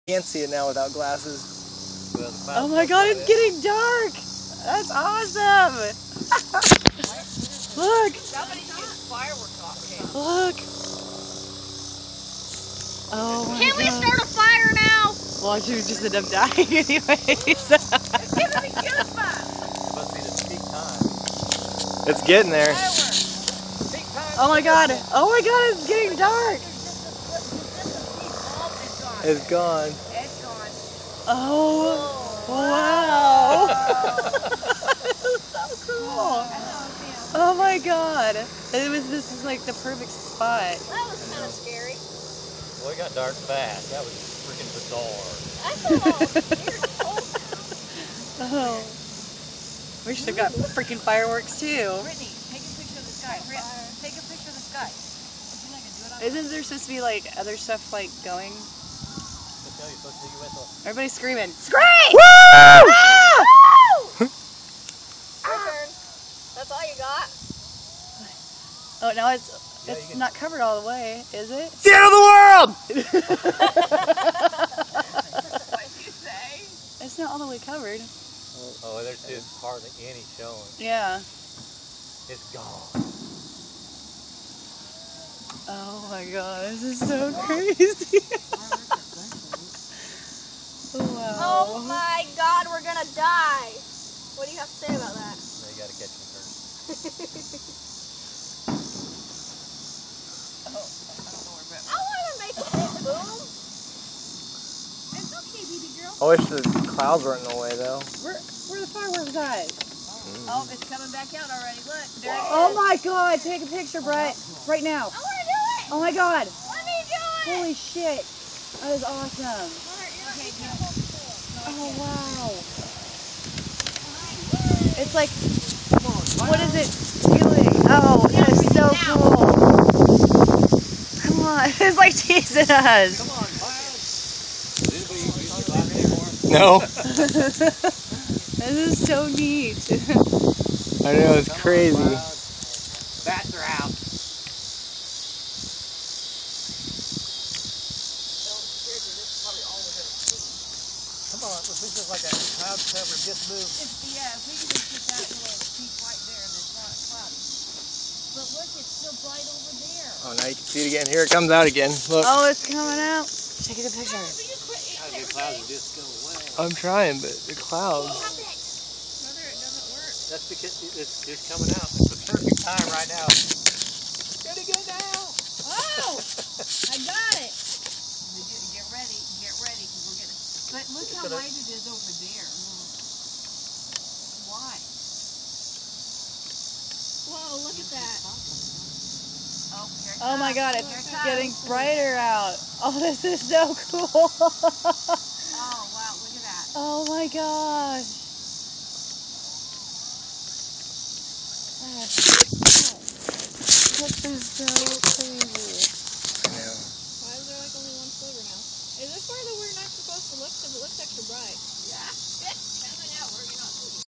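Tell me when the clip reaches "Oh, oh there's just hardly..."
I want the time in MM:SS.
01:18.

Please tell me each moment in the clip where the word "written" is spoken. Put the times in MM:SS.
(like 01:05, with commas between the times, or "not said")
not said.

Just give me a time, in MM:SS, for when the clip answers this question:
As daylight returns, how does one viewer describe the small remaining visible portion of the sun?
03:28.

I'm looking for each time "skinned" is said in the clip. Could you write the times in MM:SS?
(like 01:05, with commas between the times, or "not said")
not said.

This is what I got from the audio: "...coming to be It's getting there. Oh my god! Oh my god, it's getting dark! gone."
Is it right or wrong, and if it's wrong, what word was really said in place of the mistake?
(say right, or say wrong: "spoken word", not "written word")
wrong: "giving", not "coming".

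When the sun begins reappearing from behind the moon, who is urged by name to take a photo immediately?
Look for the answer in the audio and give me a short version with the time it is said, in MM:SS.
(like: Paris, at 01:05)
Brett, at 01:54.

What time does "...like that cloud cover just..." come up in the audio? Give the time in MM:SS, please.
02:32.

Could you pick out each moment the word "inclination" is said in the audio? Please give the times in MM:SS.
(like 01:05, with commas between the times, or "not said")
not said.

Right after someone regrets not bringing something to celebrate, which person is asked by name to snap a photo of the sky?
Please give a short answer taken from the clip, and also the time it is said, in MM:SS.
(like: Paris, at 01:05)
Brittany, at 00:52.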